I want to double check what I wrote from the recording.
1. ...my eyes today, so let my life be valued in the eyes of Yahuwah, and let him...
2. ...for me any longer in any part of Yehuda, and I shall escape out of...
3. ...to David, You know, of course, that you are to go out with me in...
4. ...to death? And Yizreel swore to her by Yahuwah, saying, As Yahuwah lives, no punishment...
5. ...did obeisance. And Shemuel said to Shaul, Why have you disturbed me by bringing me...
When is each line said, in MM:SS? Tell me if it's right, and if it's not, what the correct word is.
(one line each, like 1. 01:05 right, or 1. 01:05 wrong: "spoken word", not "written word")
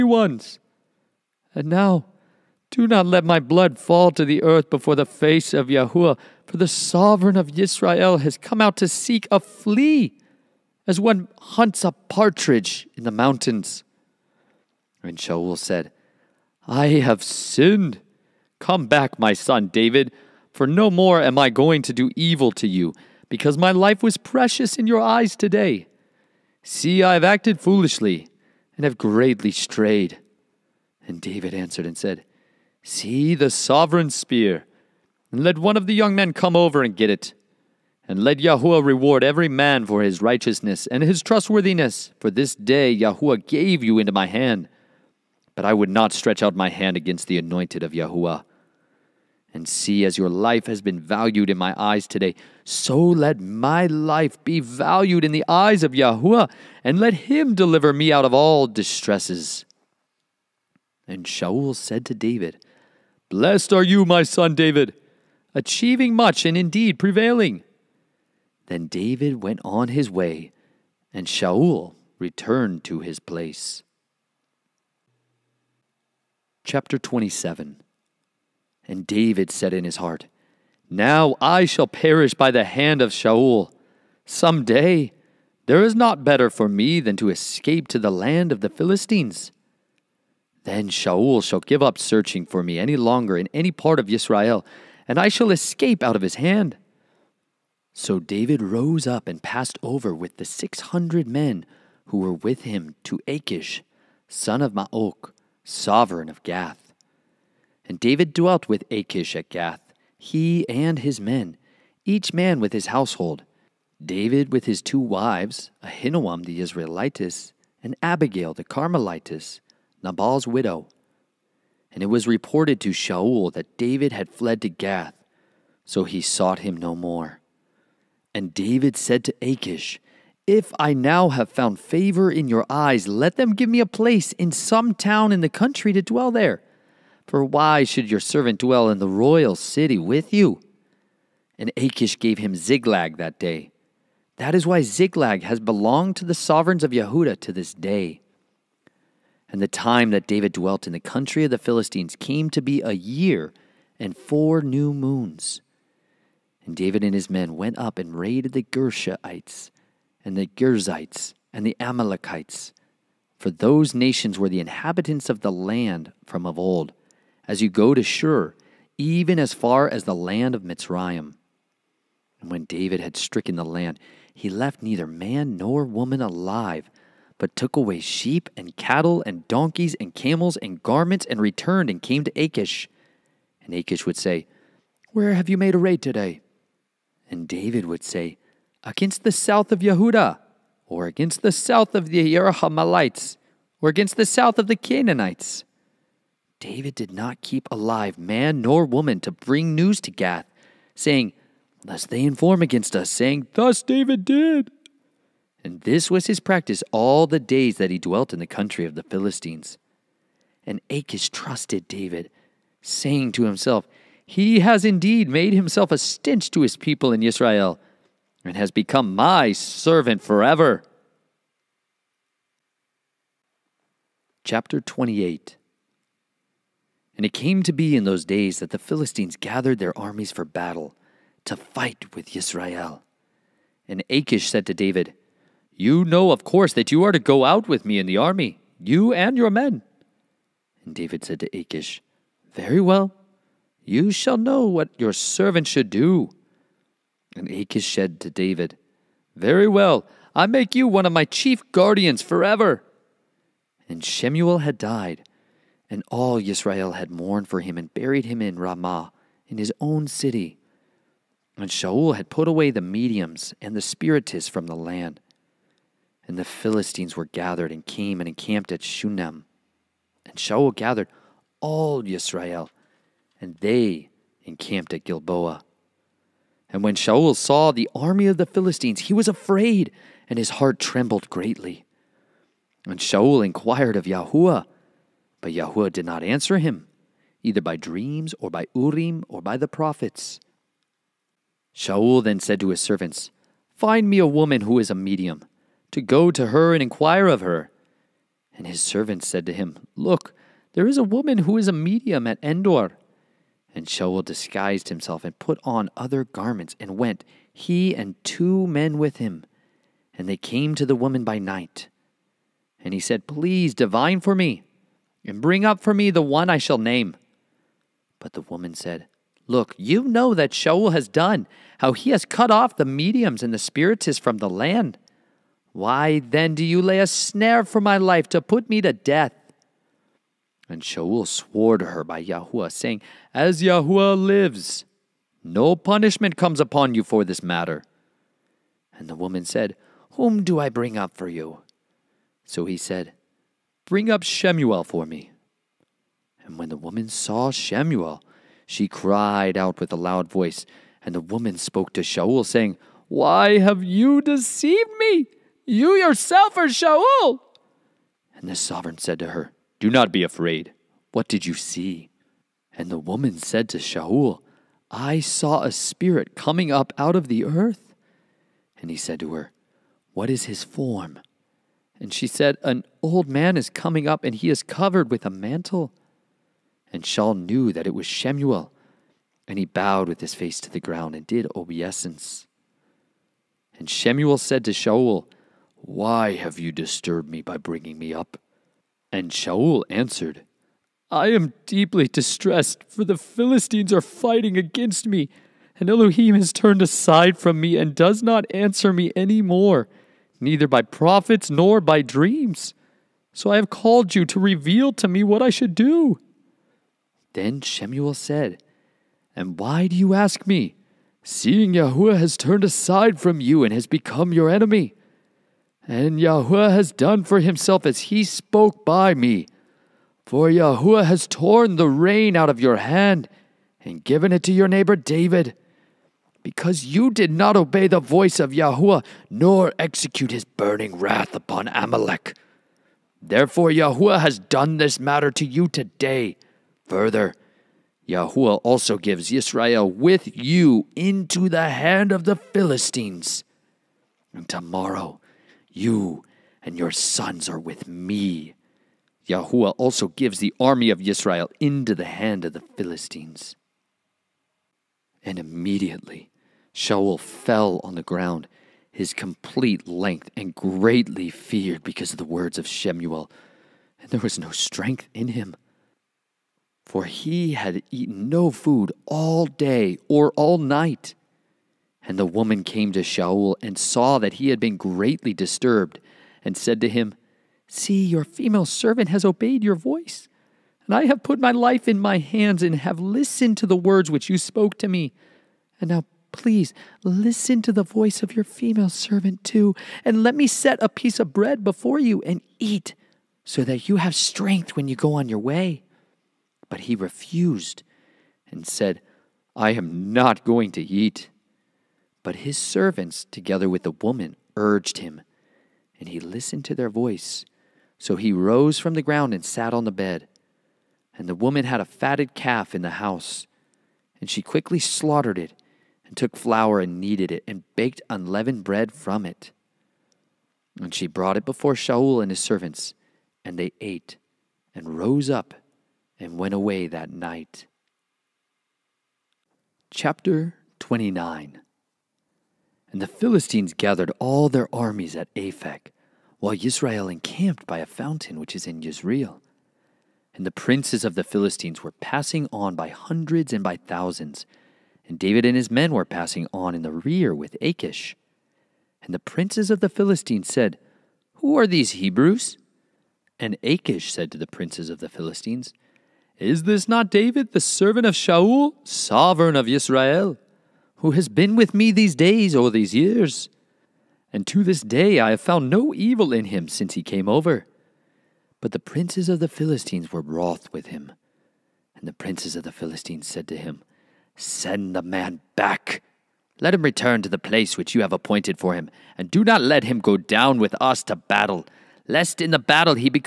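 1. 00:51 right
2. 01:32 wrong: "Israel", not "Yehuda"
3. 03:54 right
4. 05:28 wrong: "Shaul", not "Yizreel"
5. 06:21 right.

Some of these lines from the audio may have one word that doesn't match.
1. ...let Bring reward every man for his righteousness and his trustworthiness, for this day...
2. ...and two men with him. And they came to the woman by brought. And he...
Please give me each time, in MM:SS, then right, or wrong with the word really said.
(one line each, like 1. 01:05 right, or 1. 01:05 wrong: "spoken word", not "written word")
1. 00:38 wrong: "Yahuwah", not "Bring"
2. 05:07 wrong: "night", not "brought".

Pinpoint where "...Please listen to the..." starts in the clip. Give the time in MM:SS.
08:06.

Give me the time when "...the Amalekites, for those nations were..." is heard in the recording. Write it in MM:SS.
02:41.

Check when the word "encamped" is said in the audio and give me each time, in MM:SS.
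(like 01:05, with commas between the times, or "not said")
04:28, 04:34, 08:57.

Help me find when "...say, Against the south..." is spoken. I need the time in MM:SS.
03:08.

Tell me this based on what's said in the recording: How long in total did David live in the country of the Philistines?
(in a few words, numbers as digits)
A year and four new moons.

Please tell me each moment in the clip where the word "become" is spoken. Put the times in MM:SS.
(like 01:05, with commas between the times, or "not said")
03:38, 06:53.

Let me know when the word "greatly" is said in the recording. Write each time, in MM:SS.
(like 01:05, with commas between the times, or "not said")
00:28, 04:41, 07:40, 07:54.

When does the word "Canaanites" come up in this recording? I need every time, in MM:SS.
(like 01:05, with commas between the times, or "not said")
03:14.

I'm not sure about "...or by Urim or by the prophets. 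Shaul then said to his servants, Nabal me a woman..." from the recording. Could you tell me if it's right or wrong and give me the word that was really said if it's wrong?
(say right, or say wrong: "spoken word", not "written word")
wrong: "Find", not "Nabal".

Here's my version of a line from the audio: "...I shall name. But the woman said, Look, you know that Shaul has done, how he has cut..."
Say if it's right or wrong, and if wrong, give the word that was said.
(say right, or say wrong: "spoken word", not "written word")
right.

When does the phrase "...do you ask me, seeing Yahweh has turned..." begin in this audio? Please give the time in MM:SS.
06:49.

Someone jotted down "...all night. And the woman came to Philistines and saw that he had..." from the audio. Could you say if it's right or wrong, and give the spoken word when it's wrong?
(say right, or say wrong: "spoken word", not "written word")
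wrong: "Shaul", not "Philistines".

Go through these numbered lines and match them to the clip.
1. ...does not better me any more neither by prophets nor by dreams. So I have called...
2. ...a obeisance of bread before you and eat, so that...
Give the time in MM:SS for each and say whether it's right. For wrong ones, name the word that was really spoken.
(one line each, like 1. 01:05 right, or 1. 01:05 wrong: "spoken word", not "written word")
1. 06:37 wrong: "answer", not "better"
2. 08:10 wrong: "piece", not "obeisance".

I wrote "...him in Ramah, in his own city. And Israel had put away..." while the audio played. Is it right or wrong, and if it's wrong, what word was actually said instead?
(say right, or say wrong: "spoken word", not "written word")
wrong: "Shaul", not "Israel".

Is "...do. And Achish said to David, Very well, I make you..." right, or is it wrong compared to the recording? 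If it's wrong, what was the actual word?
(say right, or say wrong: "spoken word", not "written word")
right.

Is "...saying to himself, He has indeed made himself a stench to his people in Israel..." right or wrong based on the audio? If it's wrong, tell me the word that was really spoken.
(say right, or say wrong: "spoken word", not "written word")
right.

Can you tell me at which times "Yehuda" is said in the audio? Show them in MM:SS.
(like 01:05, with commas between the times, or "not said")
02:26, 03:09.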